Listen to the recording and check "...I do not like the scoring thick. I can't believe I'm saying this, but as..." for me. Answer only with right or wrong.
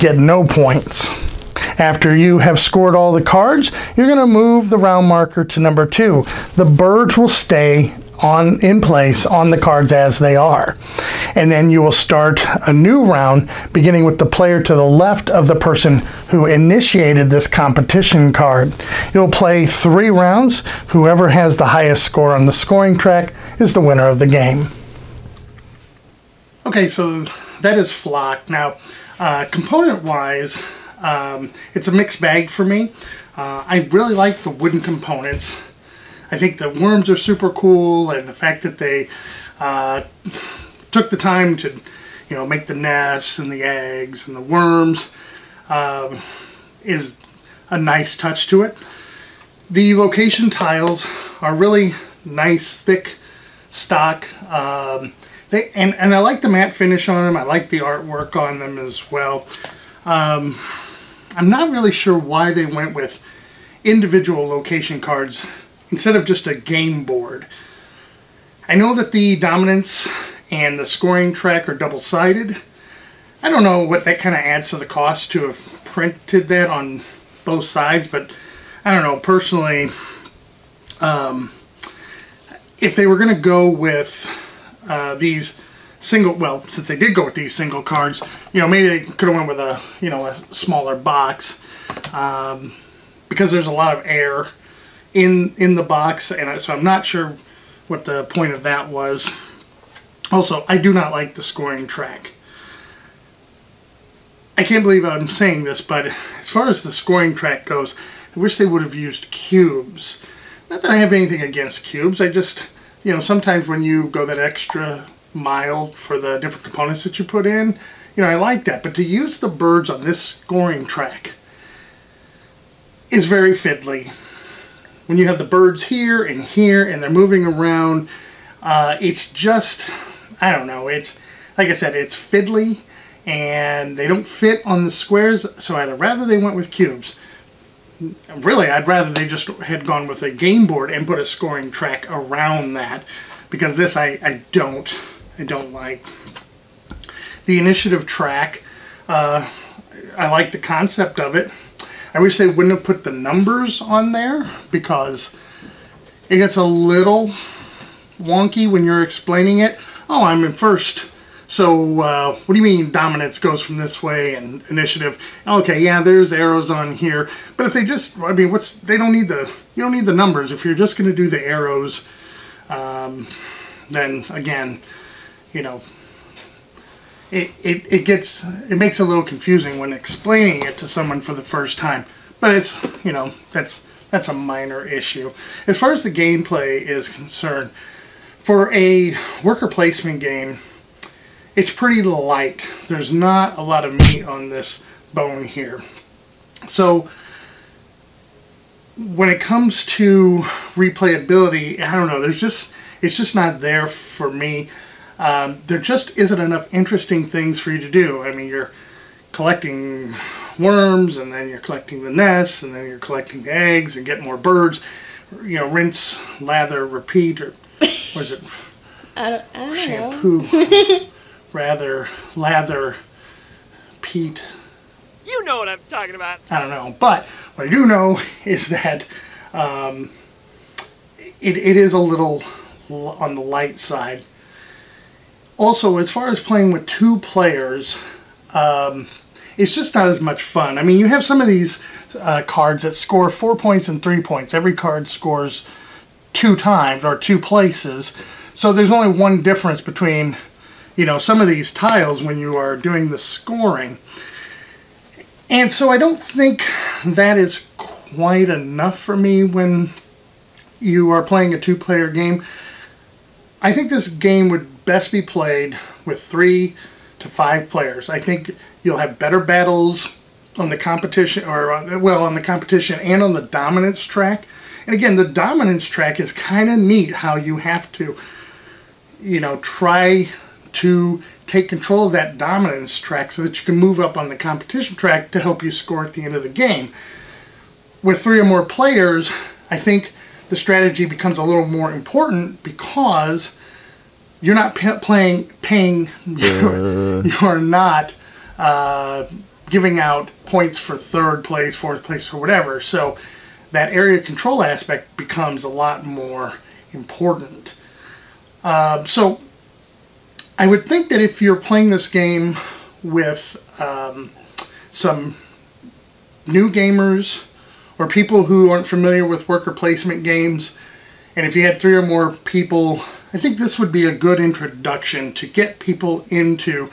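wrong.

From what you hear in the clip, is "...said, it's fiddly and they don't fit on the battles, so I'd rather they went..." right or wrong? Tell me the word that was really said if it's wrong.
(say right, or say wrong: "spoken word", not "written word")
wrong: "squares", not "battles".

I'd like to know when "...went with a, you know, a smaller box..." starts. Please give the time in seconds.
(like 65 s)
89 s.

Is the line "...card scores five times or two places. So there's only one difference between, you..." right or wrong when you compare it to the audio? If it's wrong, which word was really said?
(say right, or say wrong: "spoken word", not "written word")
wrong: "two", not "five".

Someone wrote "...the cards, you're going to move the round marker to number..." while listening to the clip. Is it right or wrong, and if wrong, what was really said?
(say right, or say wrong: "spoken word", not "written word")
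right.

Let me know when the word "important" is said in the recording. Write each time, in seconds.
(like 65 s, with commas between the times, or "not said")
291 s, 306 s.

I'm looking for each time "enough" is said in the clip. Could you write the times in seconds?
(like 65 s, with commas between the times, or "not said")
206 s, 258 s.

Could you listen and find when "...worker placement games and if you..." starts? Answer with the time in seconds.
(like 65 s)
319 s.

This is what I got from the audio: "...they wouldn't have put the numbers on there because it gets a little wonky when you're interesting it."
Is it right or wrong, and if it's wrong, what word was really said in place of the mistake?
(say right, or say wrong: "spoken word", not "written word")
wrong: "explaining", not "interesting".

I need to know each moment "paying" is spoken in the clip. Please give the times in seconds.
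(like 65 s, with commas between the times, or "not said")
295 s.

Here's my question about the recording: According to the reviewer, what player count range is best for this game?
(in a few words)
3 to 5.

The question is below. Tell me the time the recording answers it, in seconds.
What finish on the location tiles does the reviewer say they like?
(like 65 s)
56 s.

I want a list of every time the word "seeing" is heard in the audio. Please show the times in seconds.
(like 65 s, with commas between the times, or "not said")
not said.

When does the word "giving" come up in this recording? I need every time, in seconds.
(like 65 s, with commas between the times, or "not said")
299 s.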